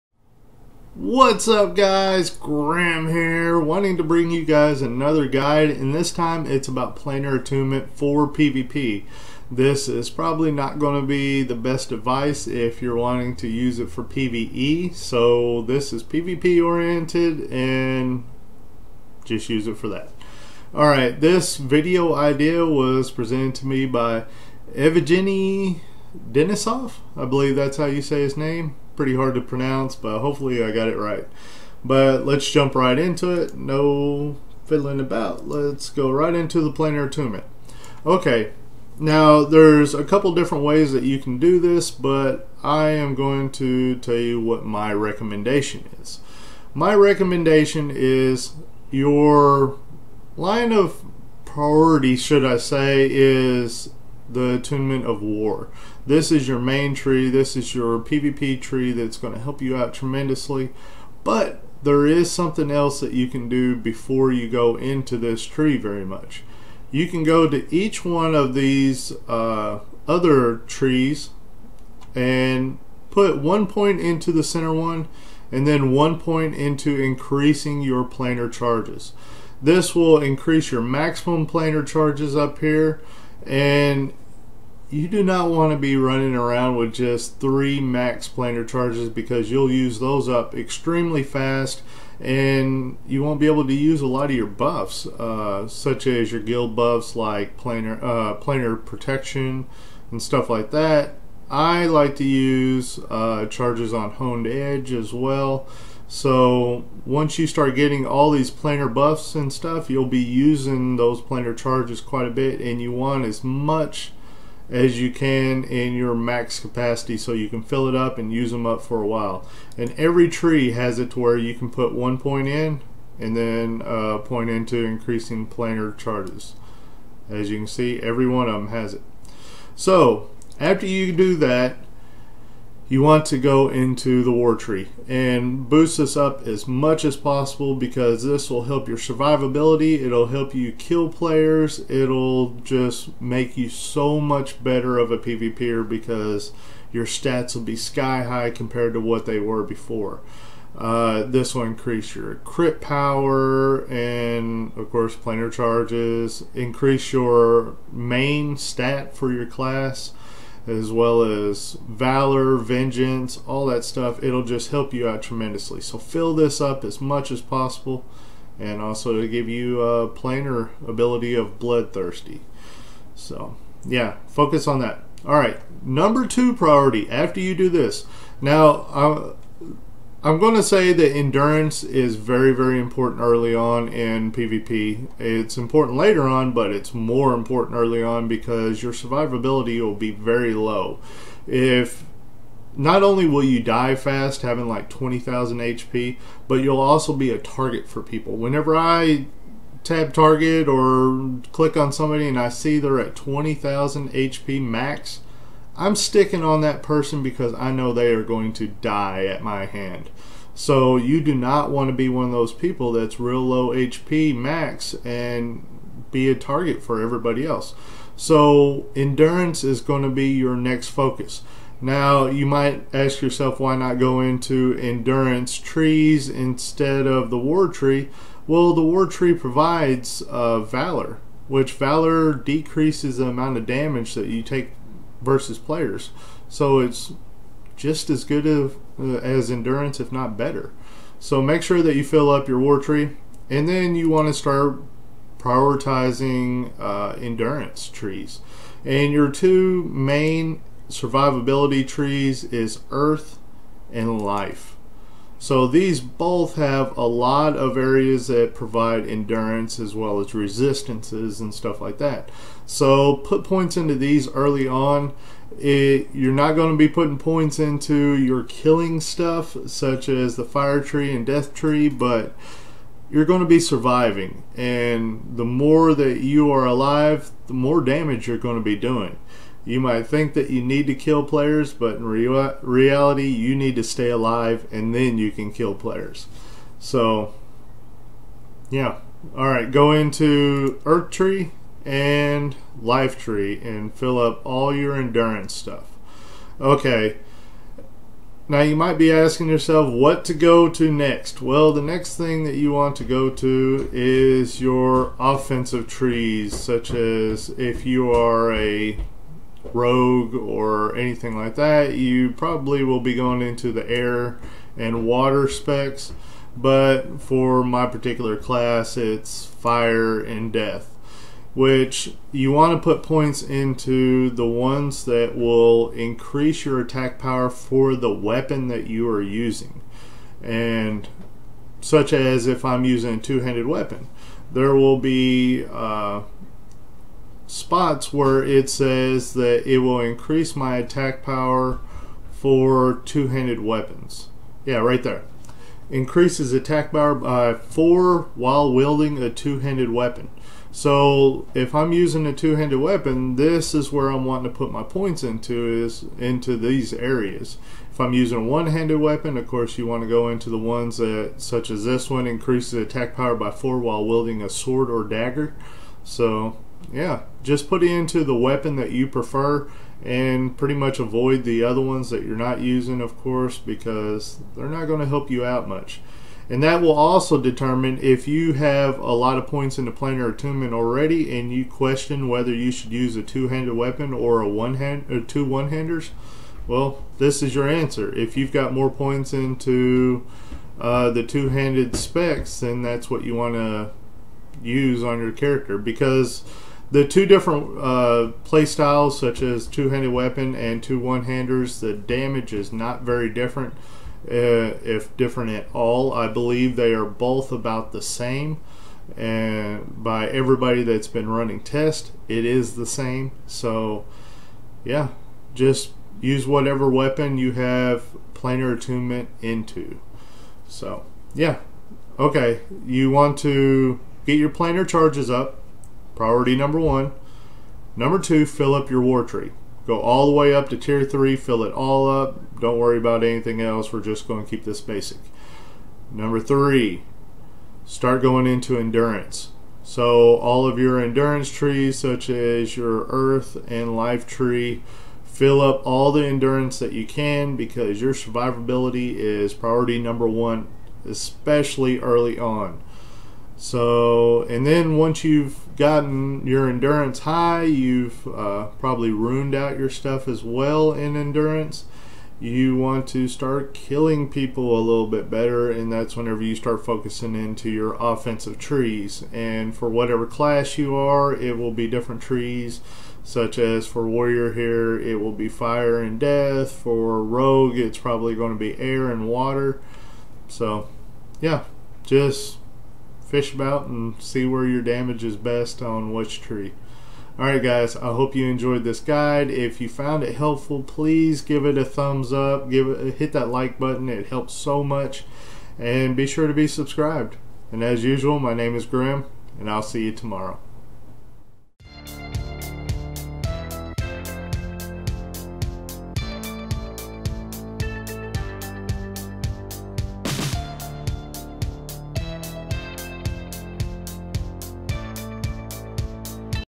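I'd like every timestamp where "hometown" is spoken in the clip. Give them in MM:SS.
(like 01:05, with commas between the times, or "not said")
not said.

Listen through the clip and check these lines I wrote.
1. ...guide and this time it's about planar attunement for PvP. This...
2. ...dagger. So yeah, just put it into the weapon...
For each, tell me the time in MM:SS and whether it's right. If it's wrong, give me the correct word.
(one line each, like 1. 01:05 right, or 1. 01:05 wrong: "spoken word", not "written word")
1. 00:05 right
2. 06:05 right.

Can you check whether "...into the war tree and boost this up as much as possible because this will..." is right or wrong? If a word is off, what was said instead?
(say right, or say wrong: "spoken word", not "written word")
right.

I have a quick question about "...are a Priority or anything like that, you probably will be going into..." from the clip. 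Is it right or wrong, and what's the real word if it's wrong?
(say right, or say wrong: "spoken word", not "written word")
wrong: "Rogue", not "Priority".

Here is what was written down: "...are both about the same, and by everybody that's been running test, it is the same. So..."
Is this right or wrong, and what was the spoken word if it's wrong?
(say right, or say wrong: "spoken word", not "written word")
right.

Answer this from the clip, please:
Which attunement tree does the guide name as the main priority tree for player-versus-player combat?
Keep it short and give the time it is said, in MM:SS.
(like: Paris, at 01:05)
attunement of war, at 00:54.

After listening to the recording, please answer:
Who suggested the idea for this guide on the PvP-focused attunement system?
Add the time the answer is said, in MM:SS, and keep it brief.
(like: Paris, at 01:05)
Evgeny Denisov, at 00:24.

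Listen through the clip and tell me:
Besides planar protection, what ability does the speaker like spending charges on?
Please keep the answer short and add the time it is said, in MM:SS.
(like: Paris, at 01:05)
honed edge, at 01:44.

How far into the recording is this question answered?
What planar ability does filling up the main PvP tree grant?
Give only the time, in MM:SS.
02:51.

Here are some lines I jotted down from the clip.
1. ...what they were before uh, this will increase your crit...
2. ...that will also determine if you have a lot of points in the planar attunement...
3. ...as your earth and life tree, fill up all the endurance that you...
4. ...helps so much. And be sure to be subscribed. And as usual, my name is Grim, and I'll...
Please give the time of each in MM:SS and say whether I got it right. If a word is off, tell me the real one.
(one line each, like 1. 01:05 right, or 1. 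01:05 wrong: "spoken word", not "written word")
1. 02:28 right
2. 06:16 right
3. 07:22 right
4. 08:14 right.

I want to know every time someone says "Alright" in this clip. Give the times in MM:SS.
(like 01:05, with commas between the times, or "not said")
00:20, 04:49, 08:07.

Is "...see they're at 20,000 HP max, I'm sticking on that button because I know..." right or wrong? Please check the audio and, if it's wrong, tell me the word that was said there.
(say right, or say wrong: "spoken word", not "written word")
wrong: "person", not "button".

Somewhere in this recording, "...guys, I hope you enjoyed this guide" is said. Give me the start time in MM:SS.
08:07.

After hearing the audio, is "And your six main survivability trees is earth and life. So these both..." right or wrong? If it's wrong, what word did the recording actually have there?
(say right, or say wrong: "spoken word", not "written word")
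wrong: "two", not "six".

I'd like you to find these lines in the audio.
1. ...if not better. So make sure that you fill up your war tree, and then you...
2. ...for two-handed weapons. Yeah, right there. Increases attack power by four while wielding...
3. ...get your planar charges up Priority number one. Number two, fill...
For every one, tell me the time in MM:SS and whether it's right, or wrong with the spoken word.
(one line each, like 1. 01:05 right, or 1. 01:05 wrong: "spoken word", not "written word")
1. 03:59 right
2. 05:42 right
3. 07:04 right.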